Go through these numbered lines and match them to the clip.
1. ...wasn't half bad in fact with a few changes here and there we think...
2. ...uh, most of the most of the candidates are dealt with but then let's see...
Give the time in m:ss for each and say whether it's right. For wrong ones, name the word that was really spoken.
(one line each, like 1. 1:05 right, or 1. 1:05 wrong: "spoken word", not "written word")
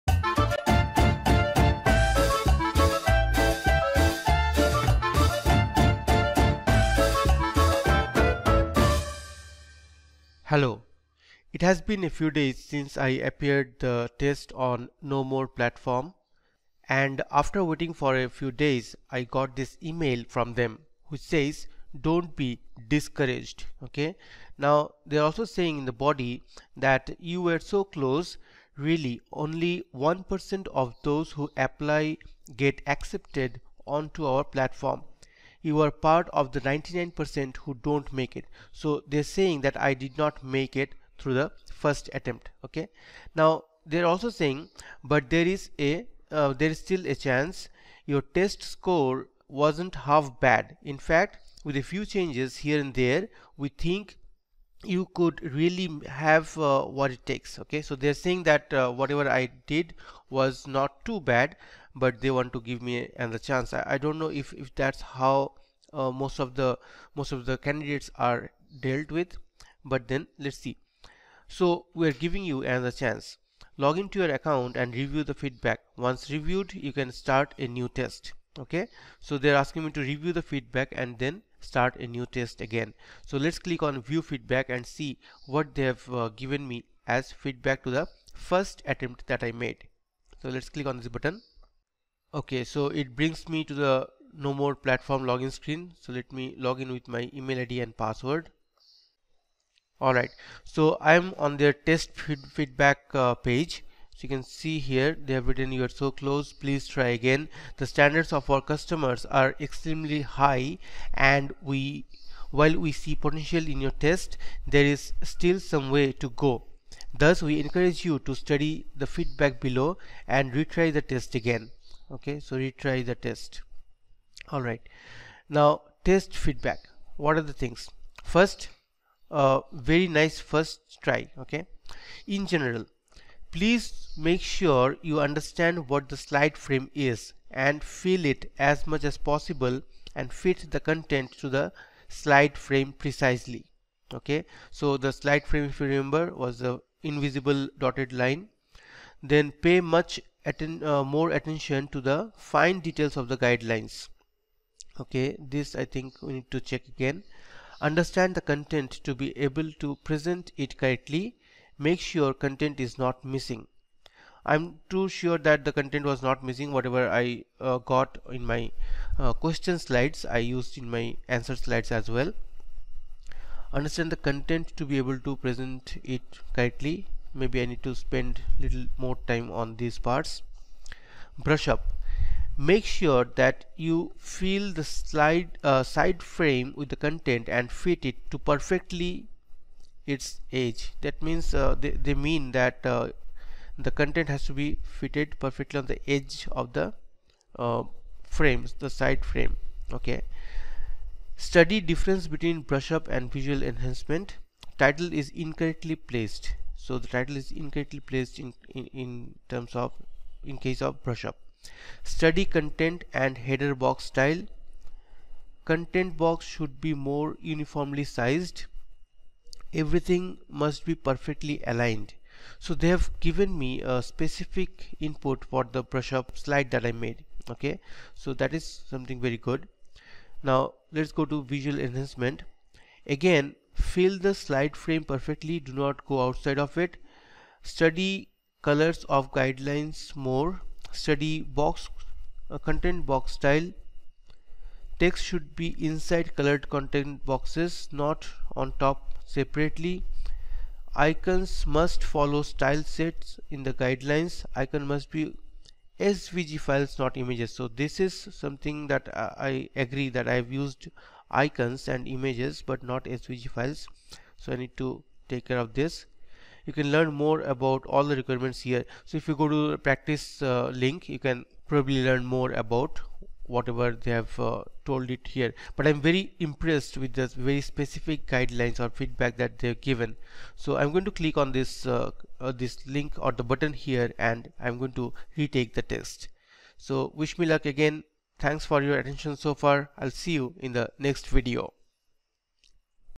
1. 0:49 right
2. 1:05 right.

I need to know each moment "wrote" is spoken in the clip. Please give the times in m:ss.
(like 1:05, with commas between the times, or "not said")
not said.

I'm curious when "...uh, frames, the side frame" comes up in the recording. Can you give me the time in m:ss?
3:17.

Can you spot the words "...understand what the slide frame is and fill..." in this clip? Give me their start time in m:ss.
2:15.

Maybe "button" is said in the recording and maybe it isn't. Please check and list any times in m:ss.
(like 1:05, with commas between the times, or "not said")
1:31, 4:43.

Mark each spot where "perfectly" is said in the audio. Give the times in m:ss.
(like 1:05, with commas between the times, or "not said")
3:08, 3:15, 3:40, 3:55.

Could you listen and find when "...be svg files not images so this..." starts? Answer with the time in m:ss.
4:15.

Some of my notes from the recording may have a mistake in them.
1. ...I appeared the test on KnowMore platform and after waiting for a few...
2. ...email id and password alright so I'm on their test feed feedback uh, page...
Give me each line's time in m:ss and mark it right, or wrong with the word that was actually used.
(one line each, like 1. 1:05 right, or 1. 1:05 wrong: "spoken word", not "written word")
1. 0:12 right
2. 1:37 right.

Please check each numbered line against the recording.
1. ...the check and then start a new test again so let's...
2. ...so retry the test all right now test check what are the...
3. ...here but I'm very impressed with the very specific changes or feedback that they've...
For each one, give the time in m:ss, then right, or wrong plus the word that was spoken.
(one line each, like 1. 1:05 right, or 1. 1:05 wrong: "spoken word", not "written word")
1. 1:20 wrong: "feedback", not "check"
2. 2:02 wrong: "feedback", not "check"
3. 4:35 wrong: "guidelines", not "changes".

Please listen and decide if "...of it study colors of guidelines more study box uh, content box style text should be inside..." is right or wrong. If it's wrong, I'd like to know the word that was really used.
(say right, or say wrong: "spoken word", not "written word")
right.